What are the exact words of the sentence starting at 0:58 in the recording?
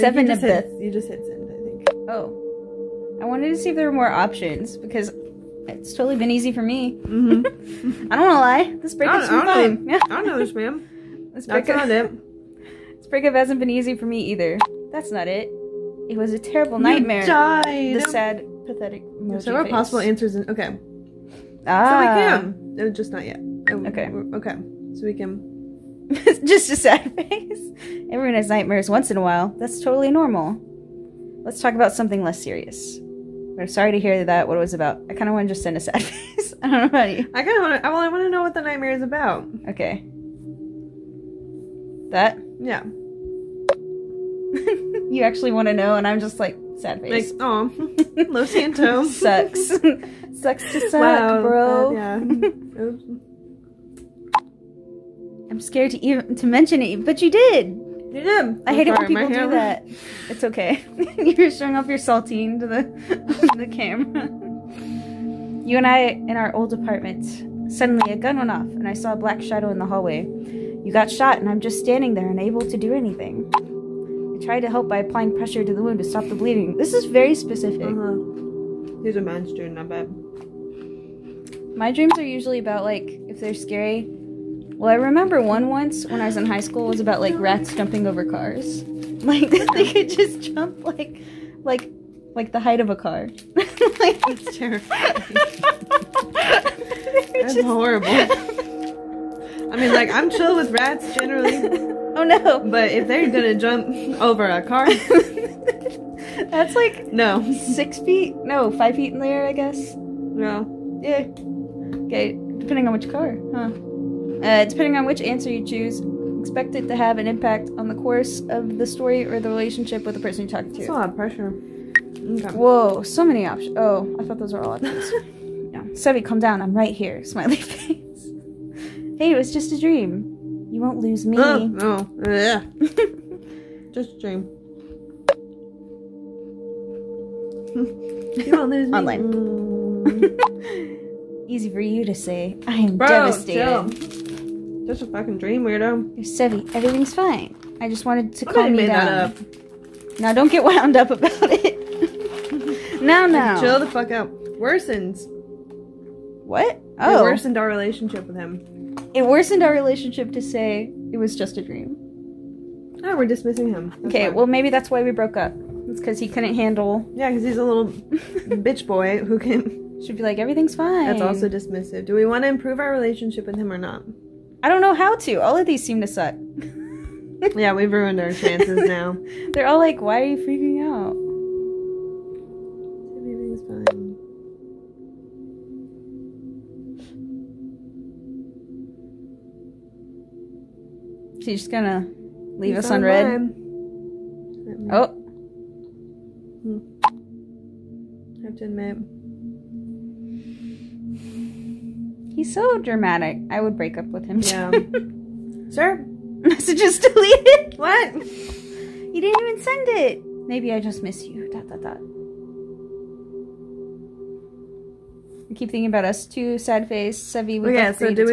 I hate it when people do that.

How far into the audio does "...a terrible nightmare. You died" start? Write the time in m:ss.
0:16.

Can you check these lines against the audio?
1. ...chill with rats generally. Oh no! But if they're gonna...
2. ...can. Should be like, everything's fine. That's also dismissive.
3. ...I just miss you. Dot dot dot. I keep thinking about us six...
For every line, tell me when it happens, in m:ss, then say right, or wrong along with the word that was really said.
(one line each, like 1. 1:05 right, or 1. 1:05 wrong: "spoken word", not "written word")
1. 1:40 right
2. 2:49 right
3. 3:30 wrong: "two", not "six".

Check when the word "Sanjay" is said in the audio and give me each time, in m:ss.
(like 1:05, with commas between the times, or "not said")
not said.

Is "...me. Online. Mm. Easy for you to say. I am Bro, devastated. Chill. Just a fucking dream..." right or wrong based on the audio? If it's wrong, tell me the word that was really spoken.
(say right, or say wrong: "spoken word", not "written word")
right.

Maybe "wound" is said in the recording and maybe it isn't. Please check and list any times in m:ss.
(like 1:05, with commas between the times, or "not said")
1:15, 2:30.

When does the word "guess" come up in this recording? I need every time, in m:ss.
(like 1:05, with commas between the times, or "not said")
1:49.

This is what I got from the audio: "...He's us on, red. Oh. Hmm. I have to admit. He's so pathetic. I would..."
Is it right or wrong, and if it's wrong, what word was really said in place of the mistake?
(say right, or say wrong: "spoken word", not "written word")
wrong: "dramatic", not "pathetic".